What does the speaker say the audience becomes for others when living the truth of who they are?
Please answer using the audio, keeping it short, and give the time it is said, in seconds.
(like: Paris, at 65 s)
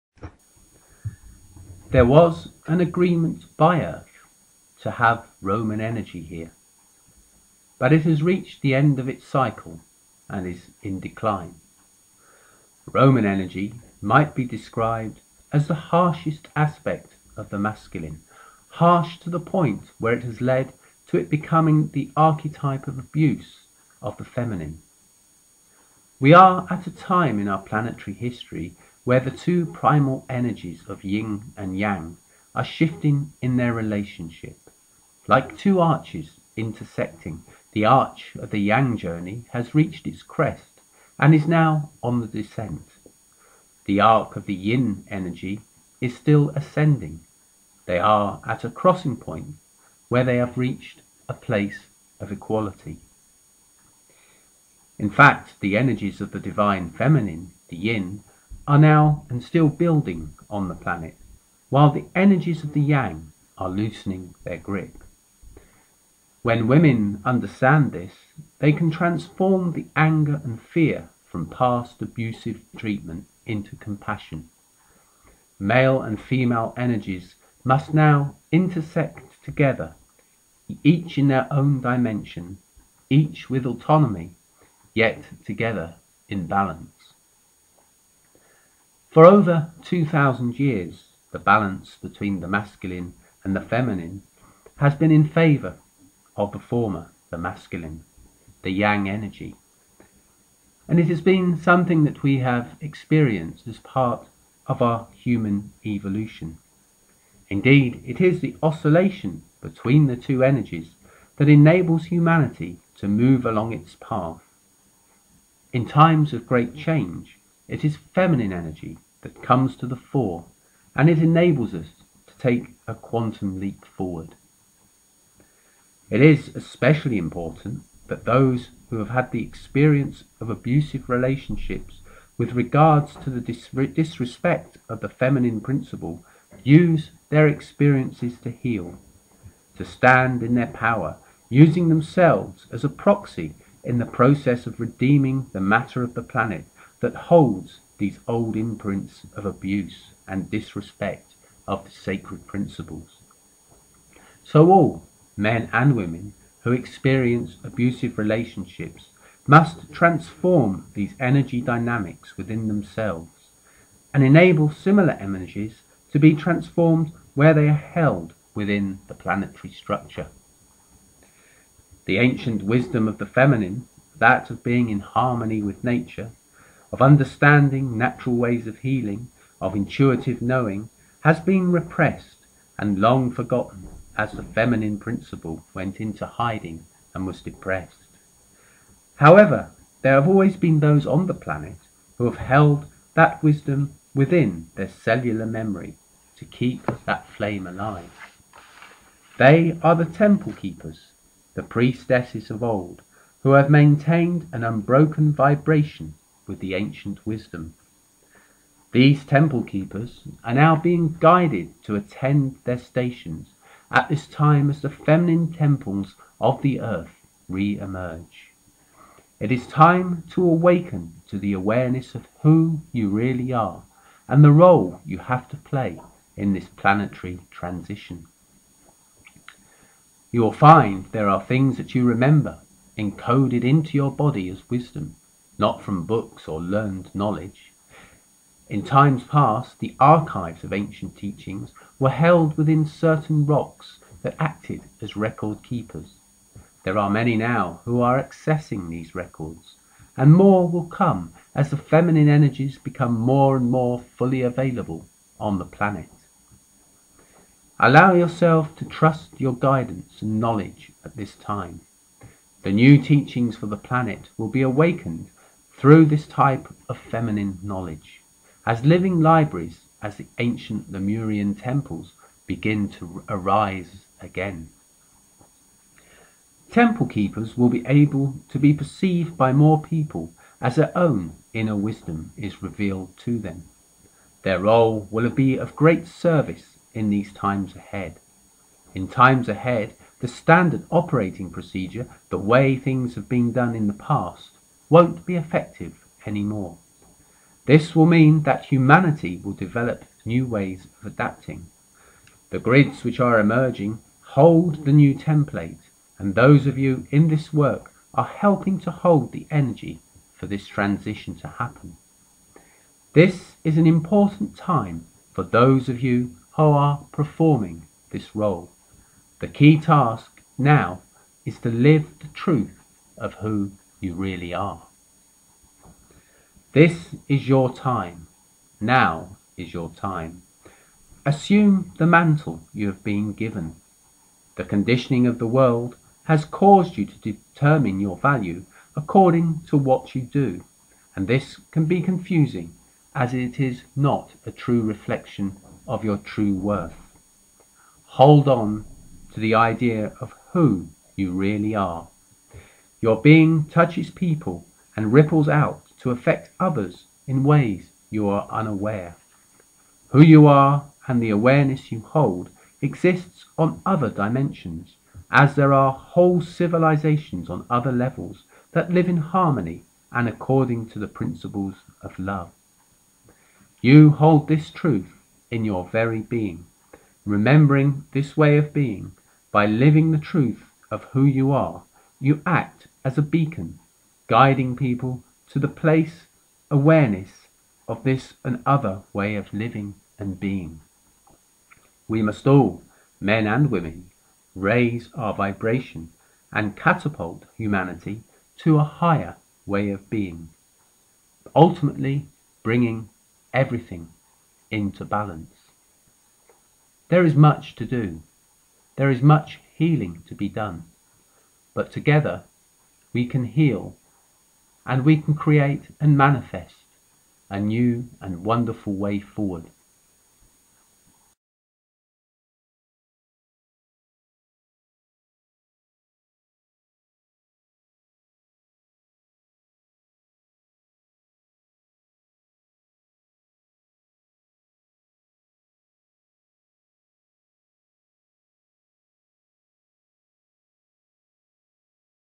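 a beacon, at 383 s.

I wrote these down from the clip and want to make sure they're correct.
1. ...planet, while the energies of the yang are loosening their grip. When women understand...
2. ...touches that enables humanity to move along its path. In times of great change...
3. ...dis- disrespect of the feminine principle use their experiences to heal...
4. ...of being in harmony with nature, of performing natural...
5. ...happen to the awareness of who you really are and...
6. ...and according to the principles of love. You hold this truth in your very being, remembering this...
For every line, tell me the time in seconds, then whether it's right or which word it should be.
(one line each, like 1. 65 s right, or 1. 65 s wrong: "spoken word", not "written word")
1. 60 s right
2. 110 s wrong: "energies", not "touches"
3. 133 s right
4. 174 s wrong: "understanding", not "performing"
5. 220 s wrong: "awaken", not "happen"
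6. 370 s right.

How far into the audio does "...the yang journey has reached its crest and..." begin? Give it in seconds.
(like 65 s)
38 s.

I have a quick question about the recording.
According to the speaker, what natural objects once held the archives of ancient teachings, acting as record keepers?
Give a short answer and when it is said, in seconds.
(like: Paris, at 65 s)
rocks, at 243 s.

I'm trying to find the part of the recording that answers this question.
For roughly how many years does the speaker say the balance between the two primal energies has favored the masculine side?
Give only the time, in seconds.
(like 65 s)
89 s.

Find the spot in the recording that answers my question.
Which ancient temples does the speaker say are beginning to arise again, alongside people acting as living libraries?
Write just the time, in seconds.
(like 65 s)
270 s.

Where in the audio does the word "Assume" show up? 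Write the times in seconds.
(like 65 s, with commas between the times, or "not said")
331 s.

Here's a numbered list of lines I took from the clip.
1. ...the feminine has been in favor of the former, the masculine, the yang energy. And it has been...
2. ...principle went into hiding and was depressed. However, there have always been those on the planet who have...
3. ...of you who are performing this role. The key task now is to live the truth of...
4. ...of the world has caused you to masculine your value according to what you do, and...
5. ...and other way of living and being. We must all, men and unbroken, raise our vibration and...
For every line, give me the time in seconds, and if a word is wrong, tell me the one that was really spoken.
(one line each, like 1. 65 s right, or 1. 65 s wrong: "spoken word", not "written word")
1. 93 s right
2. 184 s right
3. 315 s right
4. 335 s wrong: "determine", not "masculine"
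5. 388 s wrong: "women", not "unbroken".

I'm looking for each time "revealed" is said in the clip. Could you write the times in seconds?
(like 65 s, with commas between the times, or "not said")
282 s.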